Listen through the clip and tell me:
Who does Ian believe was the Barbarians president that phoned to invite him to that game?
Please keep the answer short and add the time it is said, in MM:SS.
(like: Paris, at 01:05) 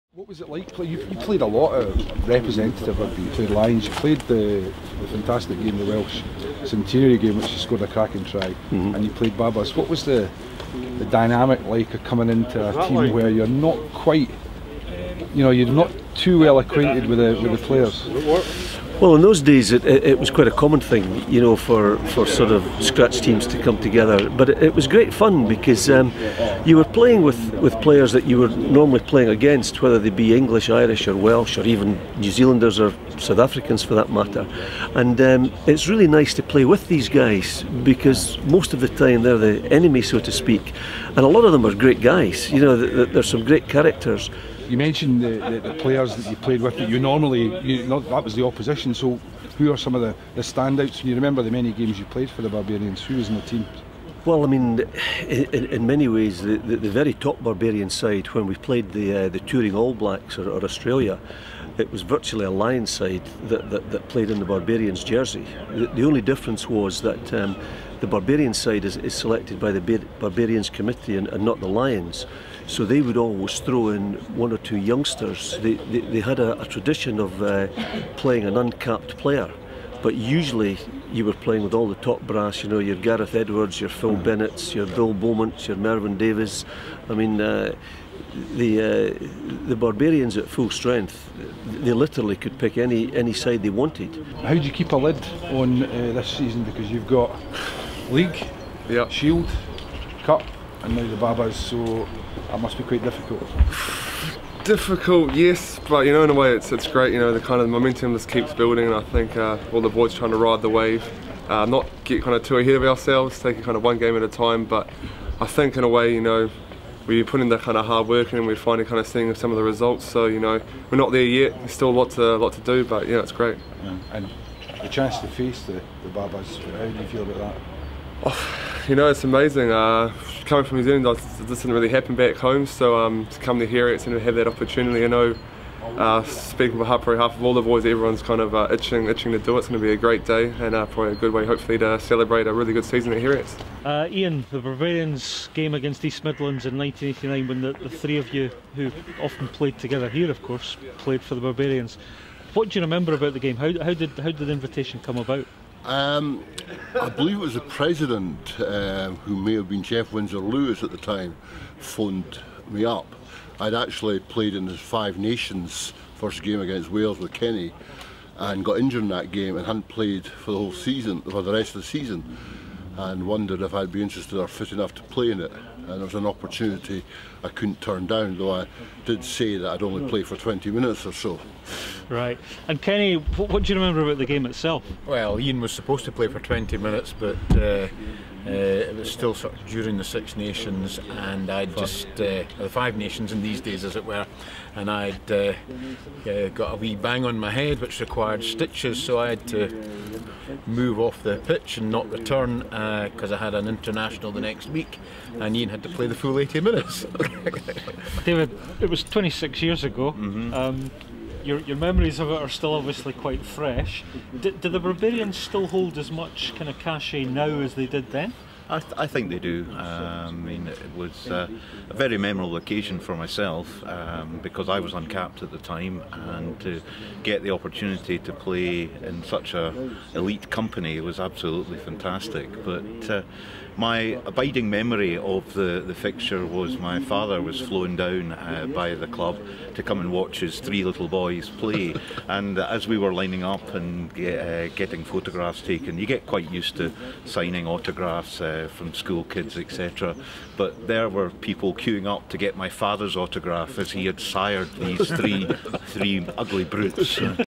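Geoff Windsor Lewis, at 02:39.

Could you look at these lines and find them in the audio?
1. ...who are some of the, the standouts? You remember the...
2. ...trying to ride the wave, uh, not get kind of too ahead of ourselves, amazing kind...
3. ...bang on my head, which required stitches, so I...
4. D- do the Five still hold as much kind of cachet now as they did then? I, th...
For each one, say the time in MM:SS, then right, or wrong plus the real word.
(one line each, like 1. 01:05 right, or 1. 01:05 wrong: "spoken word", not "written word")
1. 00:49 right
2. 01:50 wrong: "taking", not "amazing"
3. 03:16 right
4. 03:34 wrong: "Barbarians", not "Five".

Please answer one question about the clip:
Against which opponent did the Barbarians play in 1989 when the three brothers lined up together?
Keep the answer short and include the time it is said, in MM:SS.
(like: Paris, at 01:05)
East Midlands, at 02:26.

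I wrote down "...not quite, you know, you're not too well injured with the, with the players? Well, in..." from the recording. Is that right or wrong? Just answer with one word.
wrong.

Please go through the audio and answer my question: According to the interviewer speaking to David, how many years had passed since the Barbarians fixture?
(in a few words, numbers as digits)
26.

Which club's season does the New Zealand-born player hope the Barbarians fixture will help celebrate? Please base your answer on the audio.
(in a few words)
Heriot's.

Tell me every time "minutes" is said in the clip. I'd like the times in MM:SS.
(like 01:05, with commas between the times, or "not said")
03:00, 03:06, 03:26.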